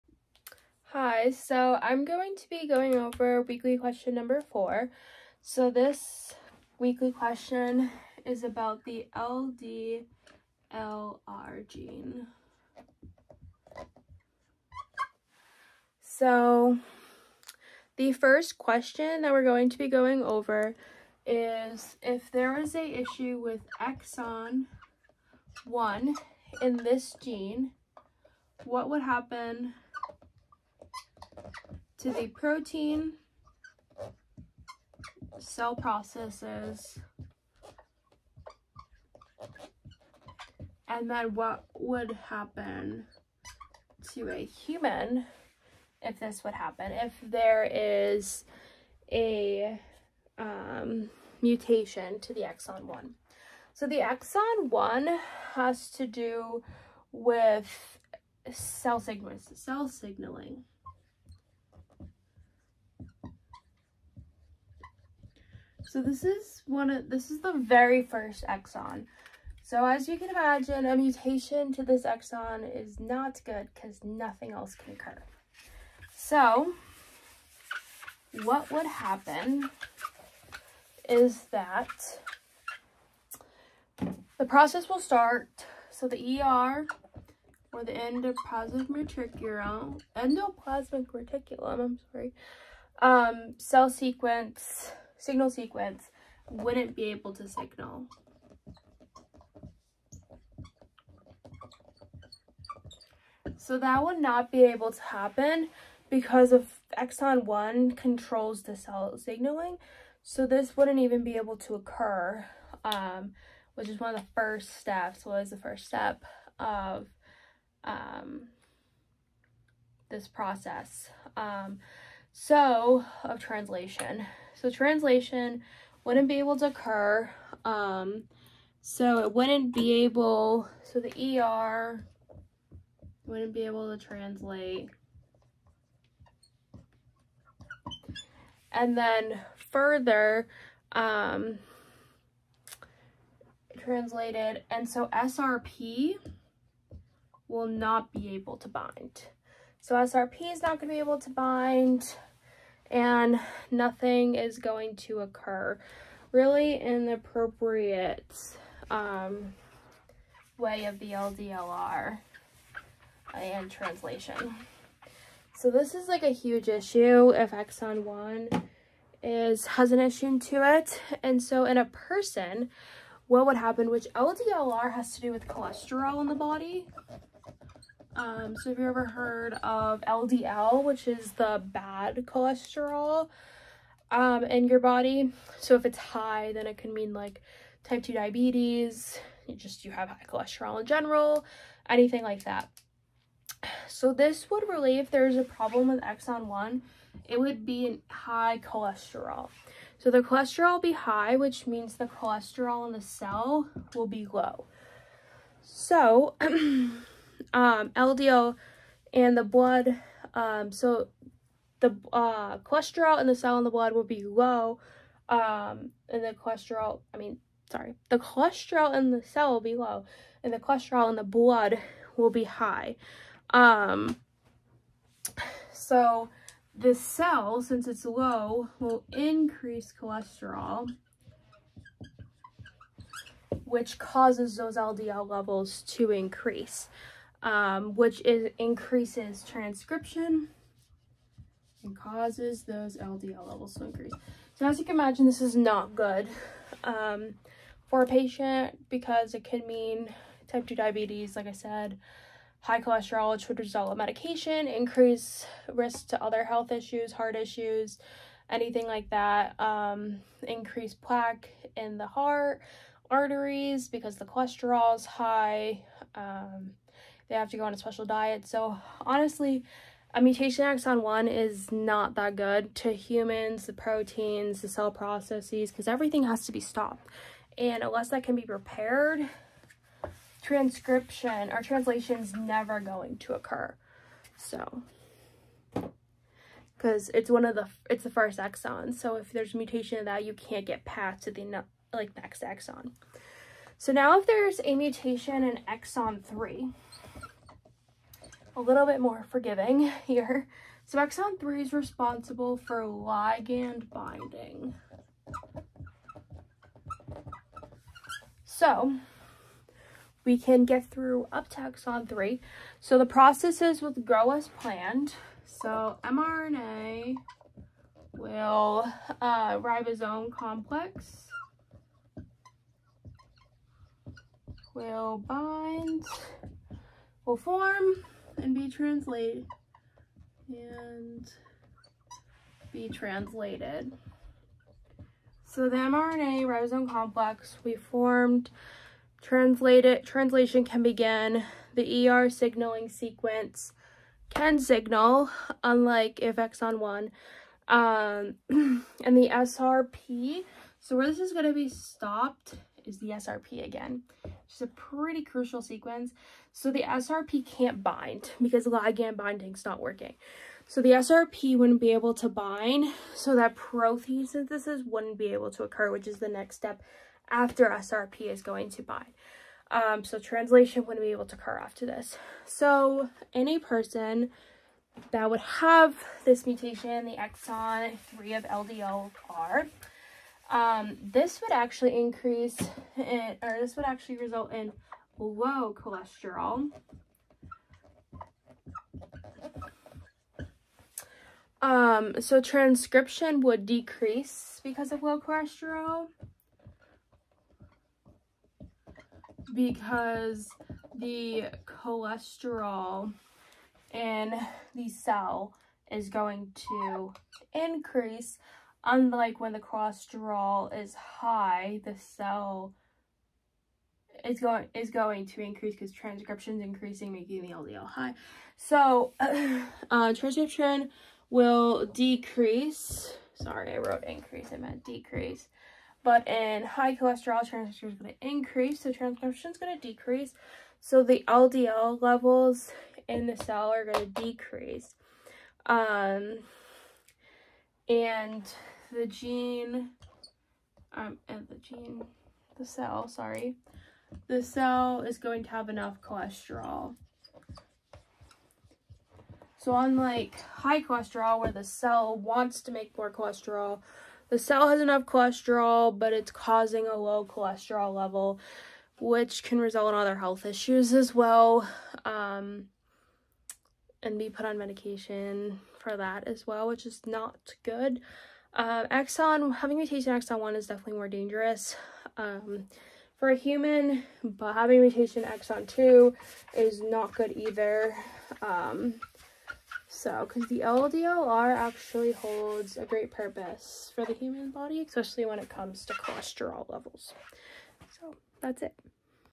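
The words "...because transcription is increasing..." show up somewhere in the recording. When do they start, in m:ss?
6:55.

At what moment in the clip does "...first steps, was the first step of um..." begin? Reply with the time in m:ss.
1:54.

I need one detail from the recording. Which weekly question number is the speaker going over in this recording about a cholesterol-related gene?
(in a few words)
4.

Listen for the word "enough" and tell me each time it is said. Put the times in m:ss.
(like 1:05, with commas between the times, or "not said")
7:25, 7:34.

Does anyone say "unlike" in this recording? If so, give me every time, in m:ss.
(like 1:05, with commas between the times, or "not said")
5:45, 6:48, 7:29.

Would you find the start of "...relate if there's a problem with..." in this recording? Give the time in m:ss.
3:14.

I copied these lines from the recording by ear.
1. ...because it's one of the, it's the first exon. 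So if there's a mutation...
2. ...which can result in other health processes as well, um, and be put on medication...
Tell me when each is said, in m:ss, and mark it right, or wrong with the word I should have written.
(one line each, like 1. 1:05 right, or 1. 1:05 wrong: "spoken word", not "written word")
1. 4:46 right
2. 7:38 wrong: "issues", not "processes".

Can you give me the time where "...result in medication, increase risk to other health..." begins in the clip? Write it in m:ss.
4:13.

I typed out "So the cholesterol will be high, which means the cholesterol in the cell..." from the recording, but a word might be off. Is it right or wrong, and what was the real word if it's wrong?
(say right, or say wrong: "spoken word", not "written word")
right.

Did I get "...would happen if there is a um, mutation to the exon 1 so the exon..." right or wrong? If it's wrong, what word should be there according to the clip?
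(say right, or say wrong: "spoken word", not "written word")
right.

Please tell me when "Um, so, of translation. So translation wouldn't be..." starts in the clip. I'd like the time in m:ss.
2:01.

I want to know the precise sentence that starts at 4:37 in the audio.
And unless that can be repaired, transcription or translation is never going to occur.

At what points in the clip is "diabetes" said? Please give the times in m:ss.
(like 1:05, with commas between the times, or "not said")
3:08, 4:10.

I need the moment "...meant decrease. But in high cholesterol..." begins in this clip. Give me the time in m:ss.
7:04.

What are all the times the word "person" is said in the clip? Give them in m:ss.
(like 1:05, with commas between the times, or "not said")
2:51, 6:13.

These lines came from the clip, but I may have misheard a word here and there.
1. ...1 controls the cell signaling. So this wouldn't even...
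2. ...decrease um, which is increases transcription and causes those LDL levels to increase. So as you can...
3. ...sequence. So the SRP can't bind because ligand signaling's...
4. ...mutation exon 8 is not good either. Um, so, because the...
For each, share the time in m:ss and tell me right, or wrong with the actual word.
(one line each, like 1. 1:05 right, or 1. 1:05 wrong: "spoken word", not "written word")
1. 1:47 right
2. 3:56 wrong: "increase", not "decrease"
3. 5:55 wrong: "binding", not "signaling"
4. 7:54 wrong: "2", not "8".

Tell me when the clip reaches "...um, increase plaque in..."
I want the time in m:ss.
4:19.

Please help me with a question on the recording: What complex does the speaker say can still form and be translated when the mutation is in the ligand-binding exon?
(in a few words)
mRNA ribosome complex.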